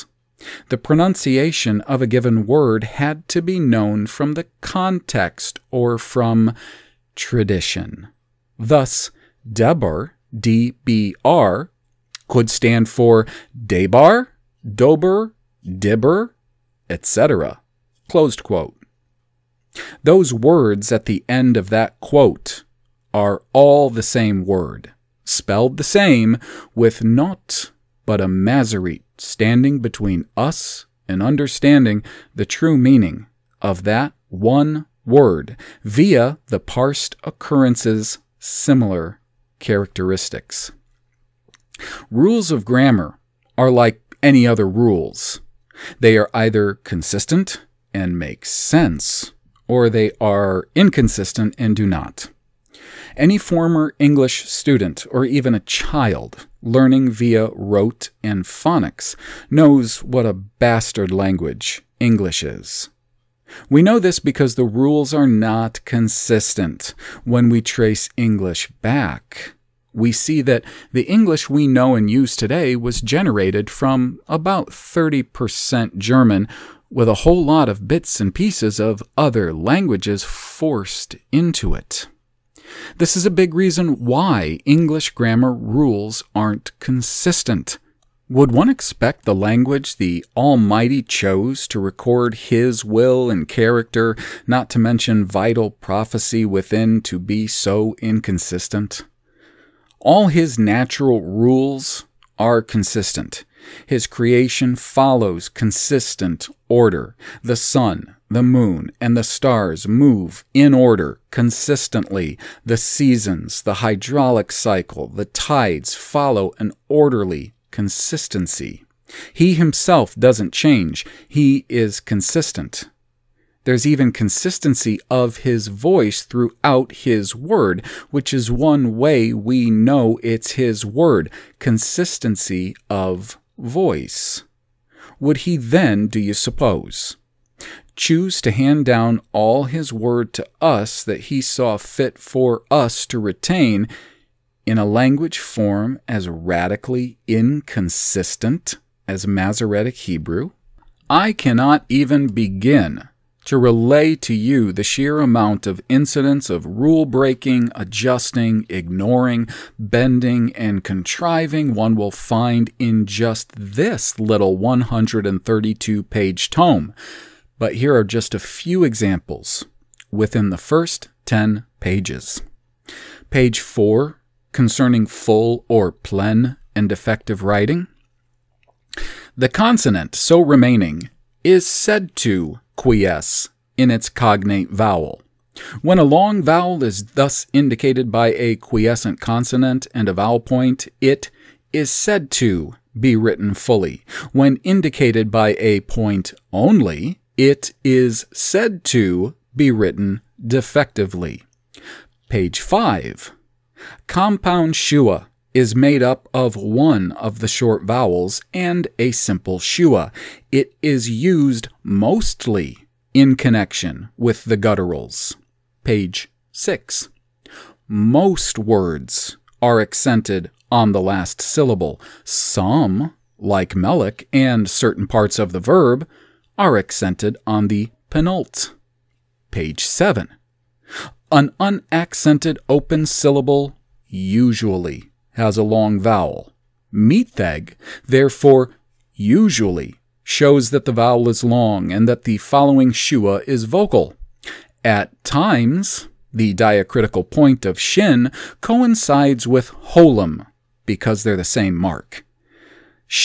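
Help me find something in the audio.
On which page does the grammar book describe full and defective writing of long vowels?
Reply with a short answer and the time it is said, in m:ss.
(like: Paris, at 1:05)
Page 4, at 2:53.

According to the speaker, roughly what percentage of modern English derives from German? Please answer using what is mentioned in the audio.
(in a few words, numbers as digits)
30%.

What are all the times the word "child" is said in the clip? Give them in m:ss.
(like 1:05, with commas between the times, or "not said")
0:55.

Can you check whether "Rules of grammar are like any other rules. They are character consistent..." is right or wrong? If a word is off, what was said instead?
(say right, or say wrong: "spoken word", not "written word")
wrong: "either", not "character".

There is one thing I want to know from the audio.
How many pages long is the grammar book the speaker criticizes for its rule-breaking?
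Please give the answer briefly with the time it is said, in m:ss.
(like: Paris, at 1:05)
132, at 2:44.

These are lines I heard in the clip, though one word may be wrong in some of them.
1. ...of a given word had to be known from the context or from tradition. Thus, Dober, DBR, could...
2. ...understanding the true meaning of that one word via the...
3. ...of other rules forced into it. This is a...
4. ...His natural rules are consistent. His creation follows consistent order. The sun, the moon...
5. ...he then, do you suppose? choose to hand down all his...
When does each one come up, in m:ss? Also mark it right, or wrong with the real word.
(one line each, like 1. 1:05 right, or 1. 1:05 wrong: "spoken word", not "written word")
1. 0:01 wrong: "Debar", not "Dober"
2. 0:31 right
3. 1:18 wrong: "languages", not "rules"
4. 1:40 right
5. 2:15 right.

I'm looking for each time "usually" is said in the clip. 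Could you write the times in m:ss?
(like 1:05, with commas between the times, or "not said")
3:54, 3:59.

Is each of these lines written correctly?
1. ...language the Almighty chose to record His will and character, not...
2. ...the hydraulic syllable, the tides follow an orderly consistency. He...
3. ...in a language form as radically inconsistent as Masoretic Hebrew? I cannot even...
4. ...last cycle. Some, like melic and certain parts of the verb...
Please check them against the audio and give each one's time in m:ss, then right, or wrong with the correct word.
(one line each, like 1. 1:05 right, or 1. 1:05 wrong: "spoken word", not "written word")
1. 1:29 right
2. 1:53 wrong: "cycle", not "syllable"
3. 2:24 right
4. 3:41 wrong: "syllable", not "cycle".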